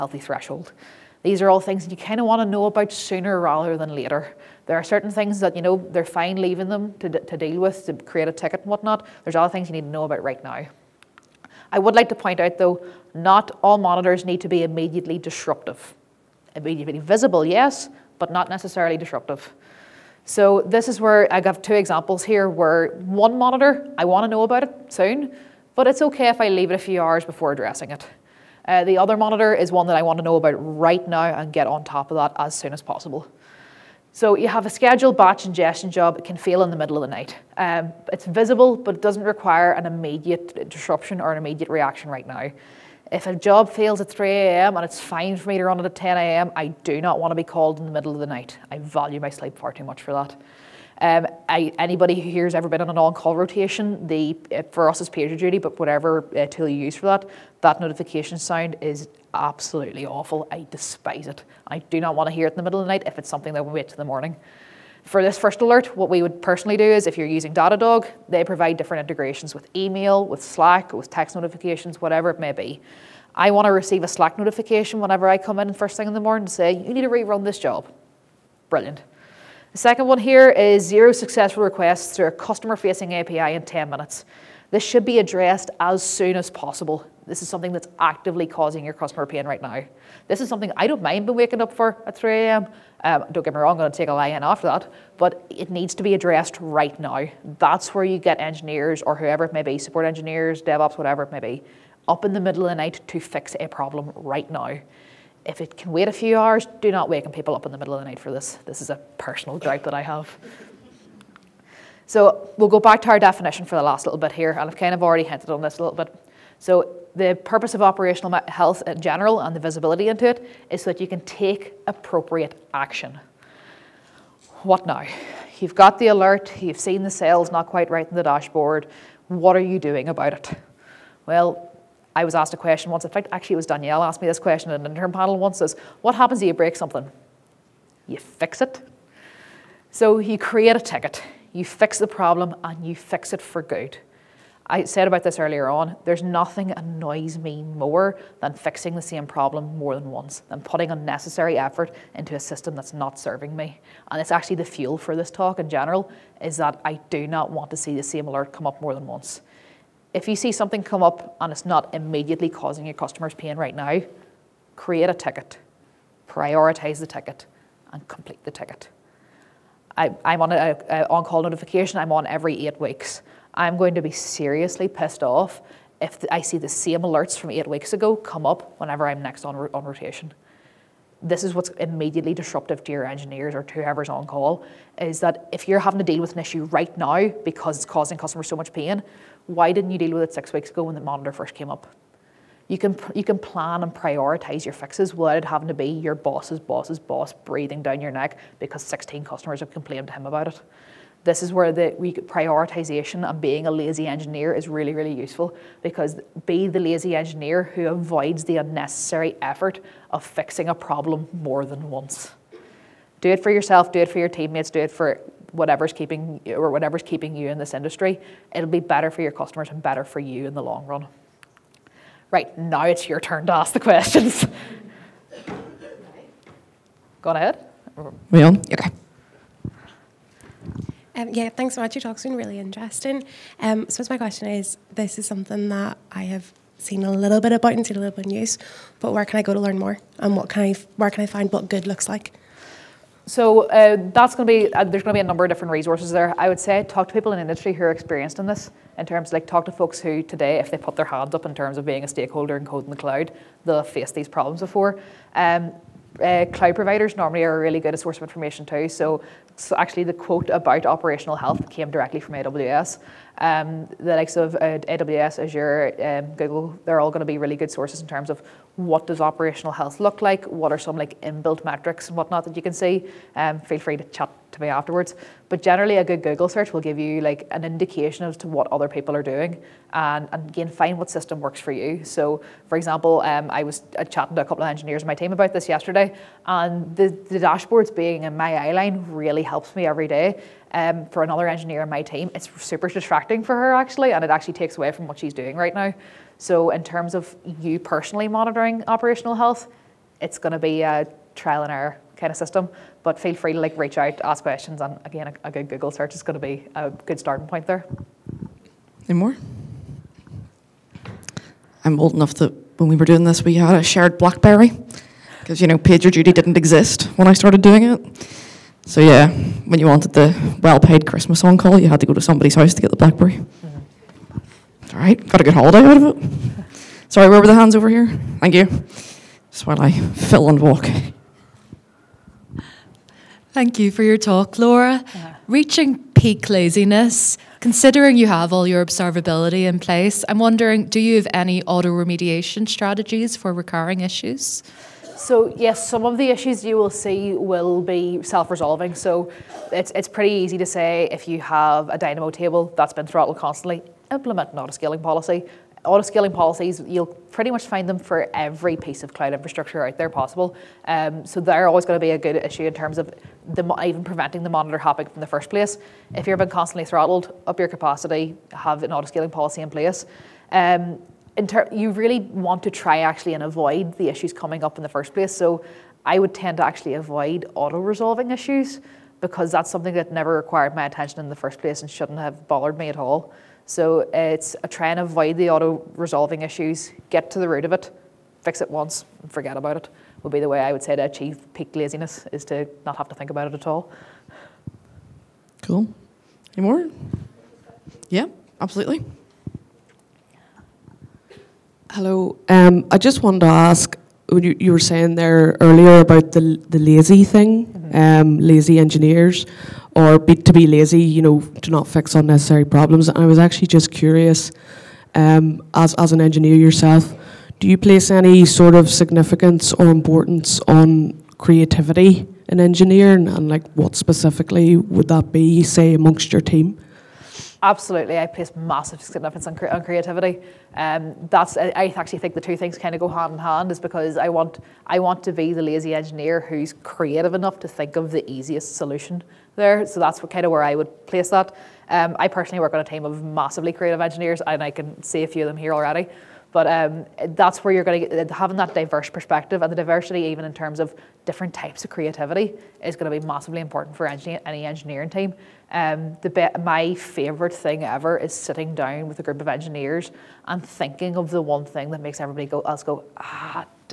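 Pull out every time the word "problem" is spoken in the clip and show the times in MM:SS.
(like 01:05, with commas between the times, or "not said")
01:43, 02:22, 02:29, 03:30, 04:14, 06:52.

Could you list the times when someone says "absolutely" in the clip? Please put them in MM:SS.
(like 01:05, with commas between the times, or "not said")
00:59, 06:38, 07:07.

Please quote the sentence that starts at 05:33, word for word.
Thank you for your talk, Laura.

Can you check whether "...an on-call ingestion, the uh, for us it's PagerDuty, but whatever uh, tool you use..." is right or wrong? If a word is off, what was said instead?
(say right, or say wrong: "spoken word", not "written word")
wrong: "rotation", not "ingestion".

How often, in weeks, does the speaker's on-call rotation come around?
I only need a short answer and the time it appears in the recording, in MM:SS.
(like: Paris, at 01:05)
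8 weeks, at 02:52.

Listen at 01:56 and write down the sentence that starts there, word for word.
So the purpose of operational health in general and the visibility into it is so that you can take appropriate action.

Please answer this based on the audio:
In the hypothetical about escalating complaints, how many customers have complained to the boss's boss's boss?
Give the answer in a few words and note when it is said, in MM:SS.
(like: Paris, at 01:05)
16, at 03:18.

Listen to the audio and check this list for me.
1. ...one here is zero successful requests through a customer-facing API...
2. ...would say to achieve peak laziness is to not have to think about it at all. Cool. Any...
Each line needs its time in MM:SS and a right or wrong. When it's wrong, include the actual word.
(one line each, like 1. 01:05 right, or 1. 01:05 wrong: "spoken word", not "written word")
1. 01:20 right
2. 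06:30 right.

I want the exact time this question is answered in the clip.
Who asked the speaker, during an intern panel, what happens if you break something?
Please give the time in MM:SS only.
02:13.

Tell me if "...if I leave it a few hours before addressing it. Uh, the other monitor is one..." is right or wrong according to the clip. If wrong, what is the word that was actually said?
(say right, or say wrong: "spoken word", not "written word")
right.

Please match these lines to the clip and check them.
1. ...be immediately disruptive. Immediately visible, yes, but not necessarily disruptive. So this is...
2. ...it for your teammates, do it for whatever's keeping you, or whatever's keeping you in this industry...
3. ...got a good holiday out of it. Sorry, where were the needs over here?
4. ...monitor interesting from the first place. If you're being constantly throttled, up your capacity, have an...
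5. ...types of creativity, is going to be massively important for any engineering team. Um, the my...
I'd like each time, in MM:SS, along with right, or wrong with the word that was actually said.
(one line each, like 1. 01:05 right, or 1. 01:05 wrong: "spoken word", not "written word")
1. 00:14 right
2. 03:33 right
3. 05:25 wrong: "hands", not "needs"
4. 06:04 wrong: "hopping", not "interesting"
5. 07:31 right.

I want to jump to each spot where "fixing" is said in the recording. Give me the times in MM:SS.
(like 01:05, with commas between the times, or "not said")
02:28, 03:30.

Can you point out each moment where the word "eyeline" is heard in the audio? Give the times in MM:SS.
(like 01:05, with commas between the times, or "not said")
04:48.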